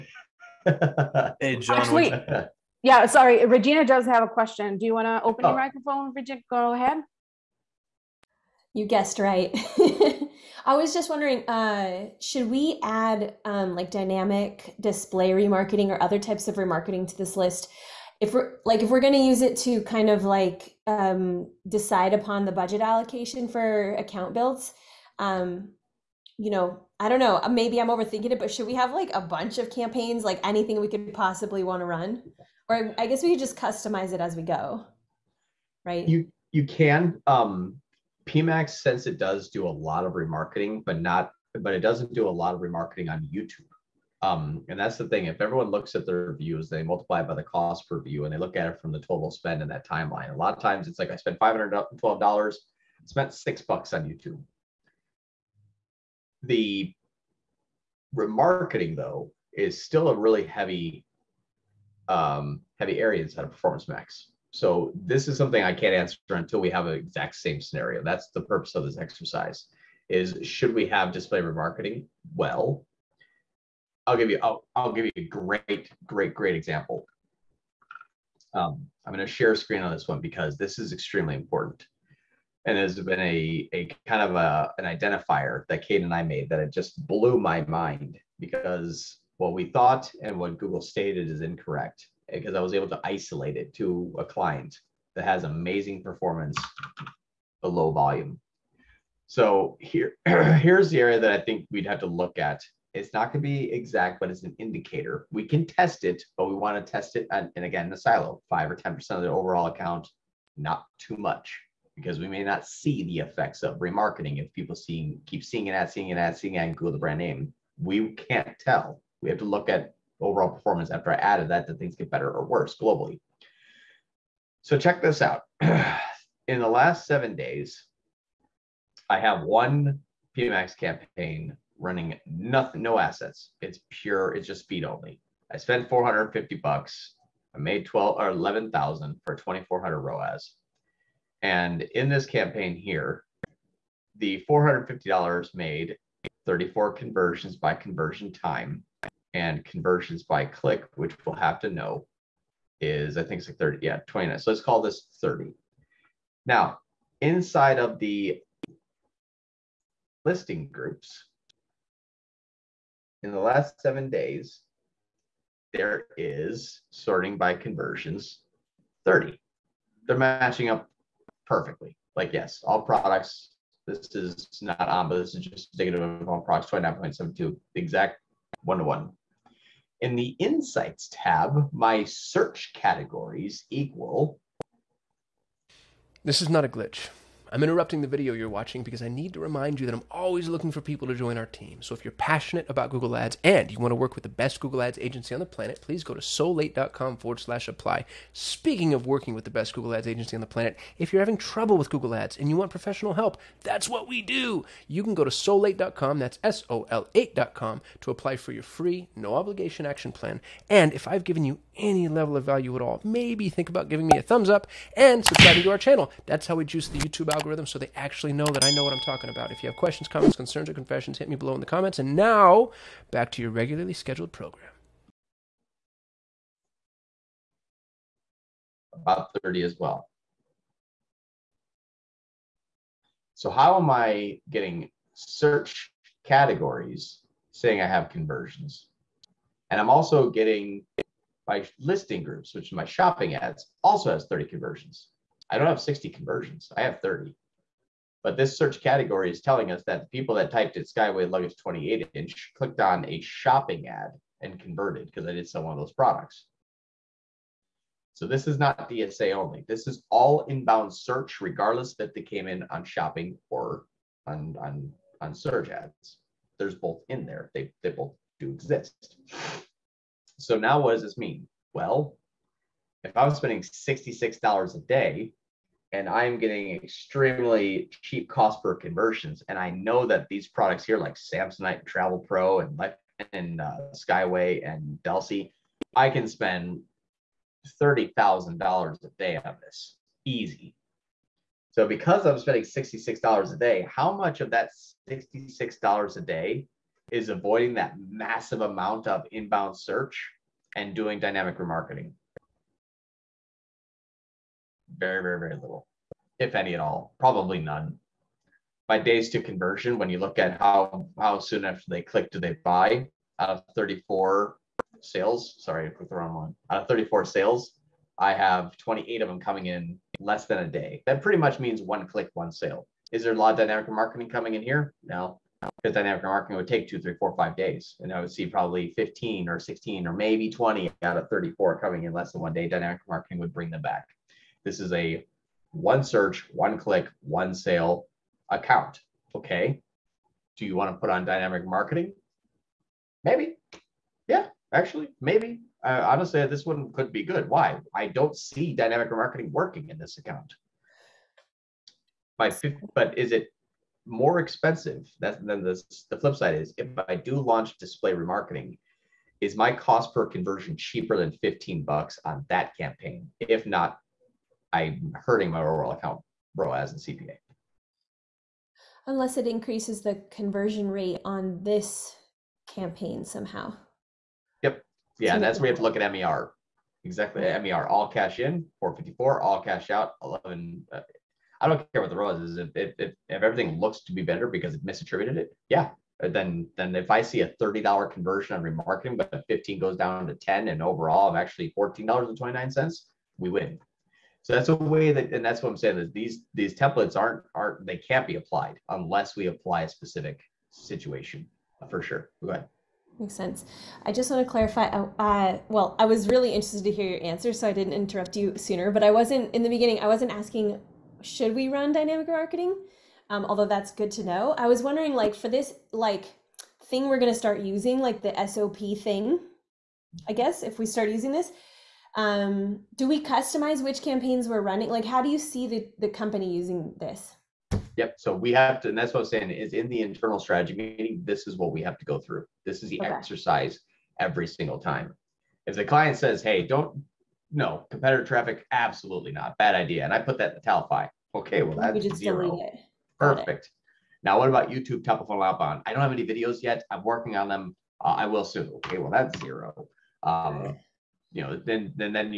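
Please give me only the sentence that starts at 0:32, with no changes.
Or I guess we could just customize it as we go, right?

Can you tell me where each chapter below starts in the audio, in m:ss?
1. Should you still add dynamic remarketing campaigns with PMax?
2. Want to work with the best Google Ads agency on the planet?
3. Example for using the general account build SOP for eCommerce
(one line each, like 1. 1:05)
1. 0:07
2. 3:05
3. 6:57.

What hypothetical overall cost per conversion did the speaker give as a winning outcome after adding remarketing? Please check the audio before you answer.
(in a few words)
$14.29.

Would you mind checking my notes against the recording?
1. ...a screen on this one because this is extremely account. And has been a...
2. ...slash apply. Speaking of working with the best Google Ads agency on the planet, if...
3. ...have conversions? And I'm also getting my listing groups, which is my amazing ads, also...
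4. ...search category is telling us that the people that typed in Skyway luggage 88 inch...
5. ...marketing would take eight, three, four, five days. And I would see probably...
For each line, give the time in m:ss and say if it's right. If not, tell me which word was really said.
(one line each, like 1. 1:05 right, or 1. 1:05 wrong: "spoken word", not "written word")
1. 1:19 wrong: "important", not "account"
2. 3:17 right
3. 3:57 wrong: "shopping", not "amazing"
4. 4:08 wrong: "28", not "88"
5. 5:26 wrong: "two", not "eight".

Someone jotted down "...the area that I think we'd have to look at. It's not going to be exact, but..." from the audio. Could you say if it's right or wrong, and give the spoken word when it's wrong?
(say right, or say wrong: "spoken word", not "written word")
right.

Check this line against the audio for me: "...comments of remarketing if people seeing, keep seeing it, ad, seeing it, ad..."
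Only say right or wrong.
wrong.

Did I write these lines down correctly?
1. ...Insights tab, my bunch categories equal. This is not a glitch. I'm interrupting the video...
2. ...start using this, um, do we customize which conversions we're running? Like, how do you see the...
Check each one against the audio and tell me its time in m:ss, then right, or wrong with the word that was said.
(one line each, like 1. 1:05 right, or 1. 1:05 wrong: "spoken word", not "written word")
1. 3:00 wrong: "search", not "bunch"
2. 7:00 wrong: "campaigns", not "conversions".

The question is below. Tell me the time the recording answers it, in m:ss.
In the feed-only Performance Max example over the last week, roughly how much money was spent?
2:15.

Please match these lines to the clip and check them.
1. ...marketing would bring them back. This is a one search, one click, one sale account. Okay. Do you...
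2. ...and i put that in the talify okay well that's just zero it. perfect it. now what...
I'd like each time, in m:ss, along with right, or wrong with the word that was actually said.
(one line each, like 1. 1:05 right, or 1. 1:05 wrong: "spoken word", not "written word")
1. 5:33 right
2. 7:20 right.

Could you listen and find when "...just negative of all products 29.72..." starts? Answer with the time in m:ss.
2:55.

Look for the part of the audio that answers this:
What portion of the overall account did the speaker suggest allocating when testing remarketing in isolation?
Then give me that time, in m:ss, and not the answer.
1:48.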